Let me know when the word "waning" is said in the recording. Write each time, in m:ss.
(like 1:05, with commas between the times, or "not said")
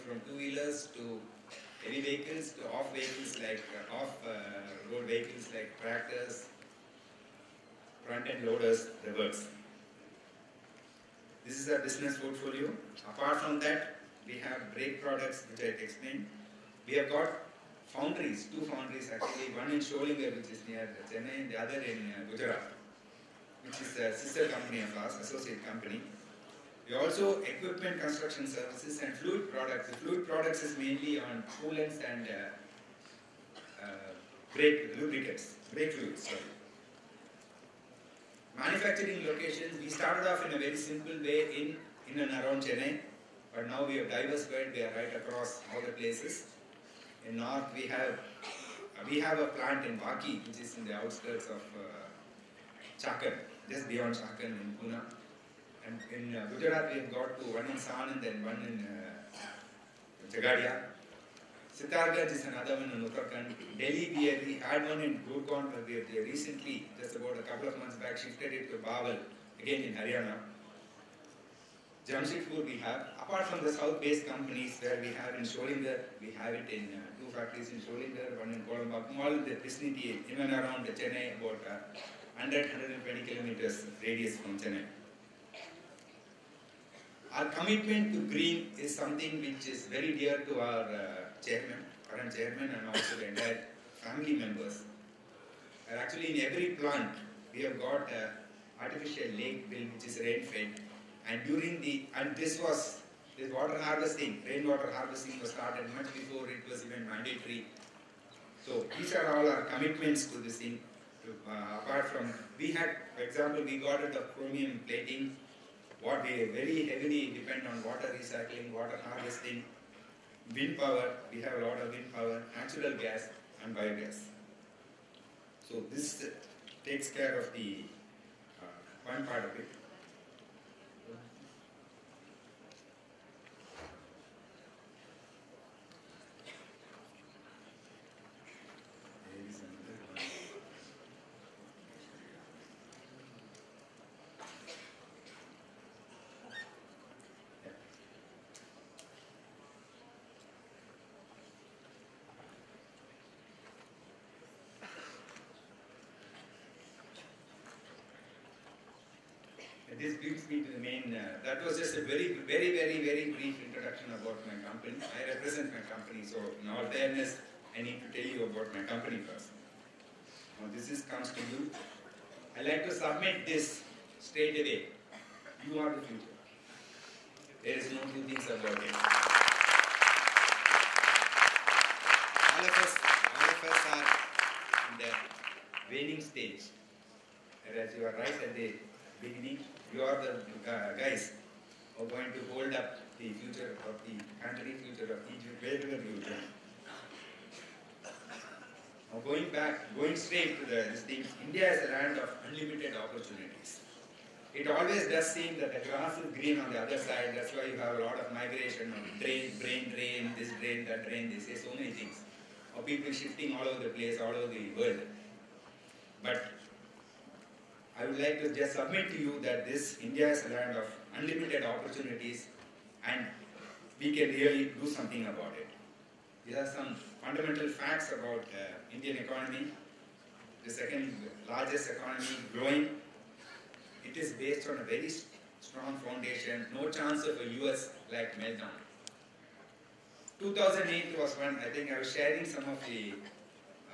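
3:05.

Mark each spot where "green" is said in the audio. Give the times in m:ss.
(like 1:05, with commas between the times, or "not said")
1:28, 3:26.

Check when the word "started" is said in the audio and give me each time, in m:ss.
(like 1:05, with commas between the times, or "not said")
0:39, 1:45.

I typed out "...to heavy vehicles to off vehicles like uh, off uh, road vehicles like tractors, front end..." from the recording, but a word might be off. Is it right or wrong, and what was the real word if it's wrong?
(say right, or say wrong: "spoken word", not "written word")
right.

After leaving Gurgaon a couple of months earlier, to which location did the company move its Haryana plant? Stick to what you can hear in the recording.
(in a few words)
Bawal.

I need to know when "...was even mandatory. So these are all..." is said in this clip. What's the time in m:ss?
1:46.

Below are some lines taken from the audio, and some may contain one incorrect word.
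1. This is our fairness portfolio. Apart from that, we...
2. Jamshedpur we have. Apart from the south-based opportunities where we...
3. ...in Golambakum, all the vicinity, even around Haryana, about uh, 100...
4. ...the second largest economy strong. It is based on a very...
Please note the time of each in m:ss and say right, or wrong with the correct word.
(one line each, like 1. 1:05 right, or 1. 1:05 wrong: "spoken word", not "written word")
1. 0:11 wrong: "business", not "fairness"
2. 1:12 wrong: "companies", not "opportunities"
3. 1:18 wrong: "Chennai", not "Haryana"
4. 3:50 wrong: "growing", not "strong".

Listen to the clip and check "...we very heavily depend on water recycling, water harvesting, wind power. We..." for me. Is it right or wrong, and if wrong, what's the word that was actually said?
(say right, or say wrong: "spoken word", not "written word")
right.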